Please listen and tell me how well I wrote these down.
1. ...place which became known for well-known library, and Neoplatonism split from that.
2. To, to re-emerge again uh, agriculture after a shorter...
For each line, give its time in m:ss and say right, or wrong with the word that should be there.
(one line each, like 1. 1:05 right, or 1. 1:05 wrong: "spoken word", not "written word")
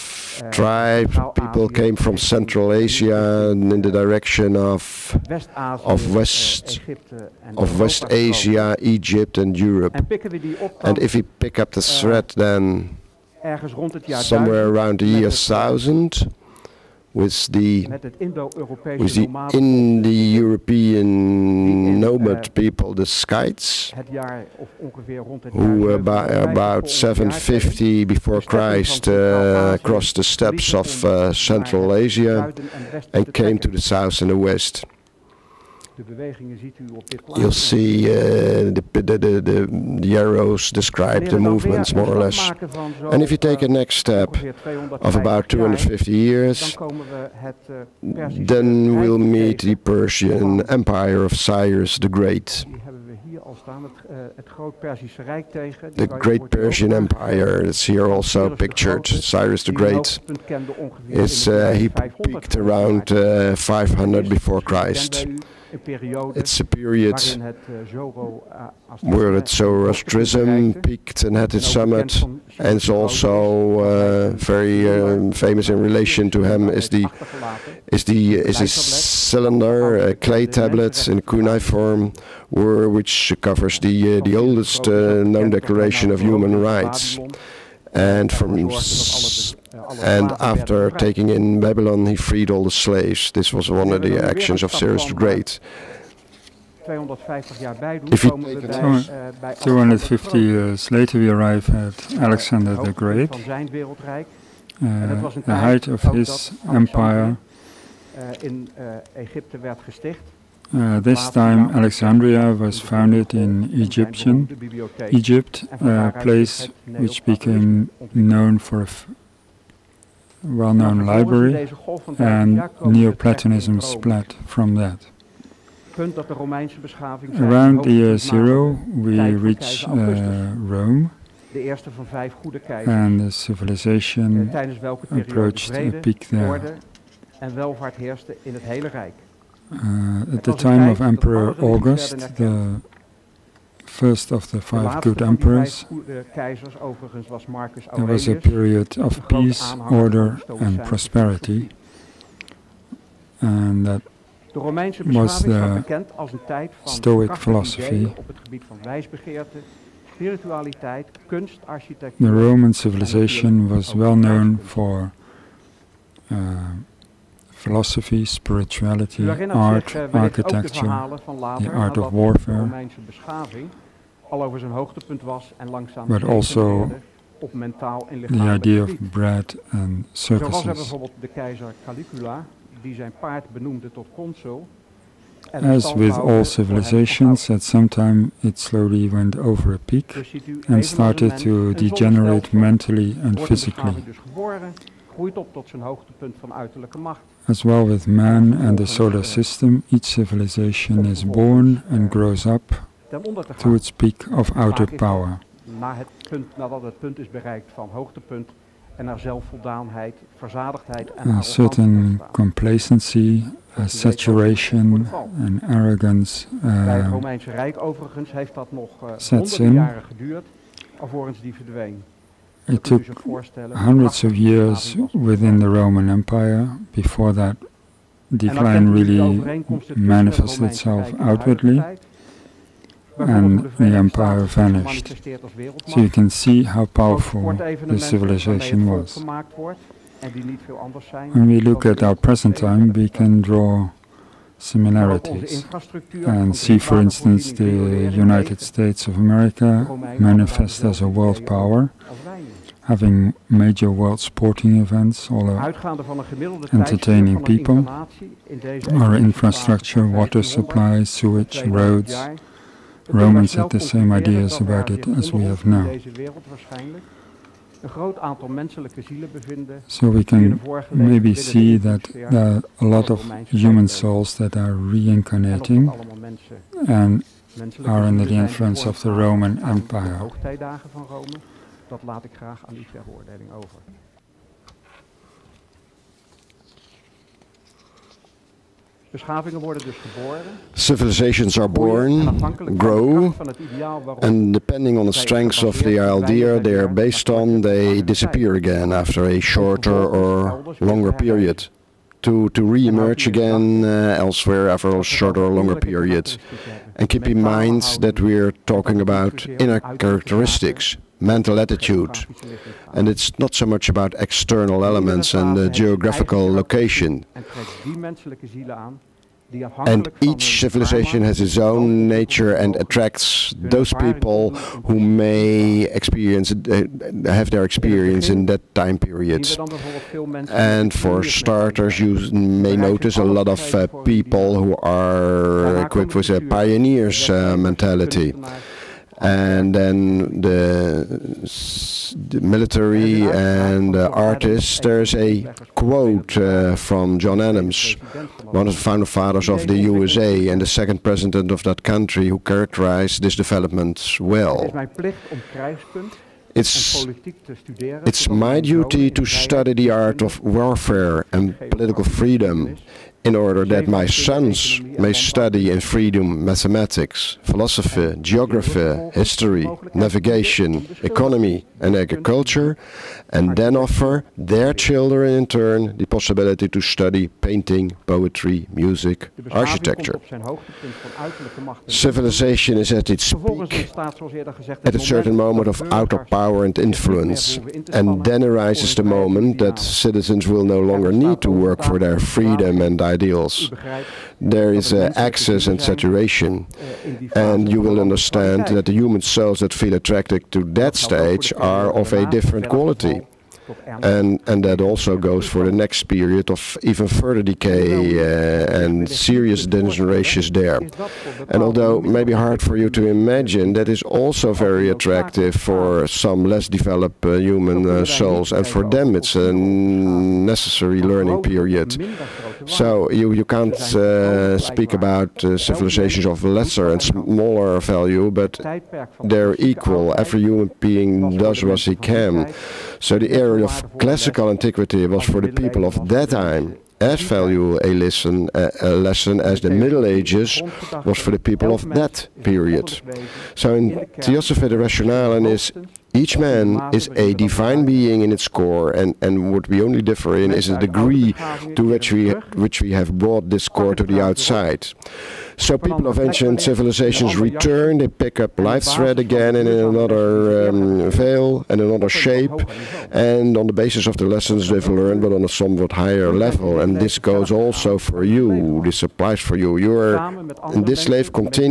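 1. 1:56 right
2. 5:02 wrong: "elsewhere", not "agriculture".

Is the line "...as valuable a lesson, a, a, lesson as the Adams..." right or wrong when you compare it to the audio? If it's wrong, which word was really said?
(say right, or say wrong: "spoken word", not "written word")
wrong: "Middle", not "Adams".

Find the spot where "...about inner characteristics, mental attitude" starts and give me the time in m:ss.
5:08.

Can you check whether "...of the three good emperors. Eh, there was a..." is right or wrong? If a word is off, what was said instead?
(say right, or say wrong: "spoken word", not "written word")
wrong: "five", not "three".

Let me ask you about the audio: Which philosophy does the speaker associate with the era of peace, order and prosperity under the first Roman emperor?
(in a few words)
Stoic philosophy.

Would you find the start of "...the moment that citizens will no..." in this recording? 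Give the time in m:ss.
6:28.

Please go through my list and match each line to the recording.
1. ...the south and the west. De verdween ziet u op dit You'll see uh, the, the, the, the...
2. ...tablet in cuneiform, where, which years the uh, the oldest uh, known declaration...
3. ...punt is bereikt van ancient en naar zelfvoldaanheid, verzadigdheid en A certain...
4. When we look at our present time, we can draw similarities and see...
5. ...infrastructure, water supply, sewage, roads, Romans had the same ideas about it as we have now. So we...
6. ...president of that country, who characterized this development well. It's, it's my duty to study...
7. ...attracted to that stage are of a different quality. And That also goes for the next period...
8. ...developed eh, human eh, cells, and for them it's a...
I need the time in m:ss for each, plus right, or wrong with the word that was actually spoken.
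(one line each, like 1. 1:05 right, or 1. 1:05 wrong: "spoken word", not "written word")
1. 0:33 wrong: "bewegingen", not "verdween"
2. 1:20 wrong: "covers", not "years"
3. 3:26 wrong: "hoogtepunt", not "ancient"
4. 4:01 right
5. 4:19 right
6. 5:51 right
7. 6:39 right
8. 6:56 wrong: "souls", not "cells".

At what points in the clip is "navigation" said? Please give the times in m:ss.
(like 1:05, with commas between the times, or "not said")
6:09.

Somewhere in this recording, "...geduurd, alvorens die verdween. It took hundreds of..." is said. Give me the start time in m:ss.
3:40.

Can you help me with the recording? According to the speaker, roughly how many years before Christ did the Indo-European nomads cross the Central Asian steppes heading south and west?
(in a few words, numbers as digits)
750.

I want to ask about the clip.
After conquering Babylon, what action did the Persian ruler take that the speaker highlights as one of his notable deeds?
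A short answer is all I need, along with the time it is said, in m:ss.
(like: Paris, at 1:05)
freed all the slaves, at 1:32.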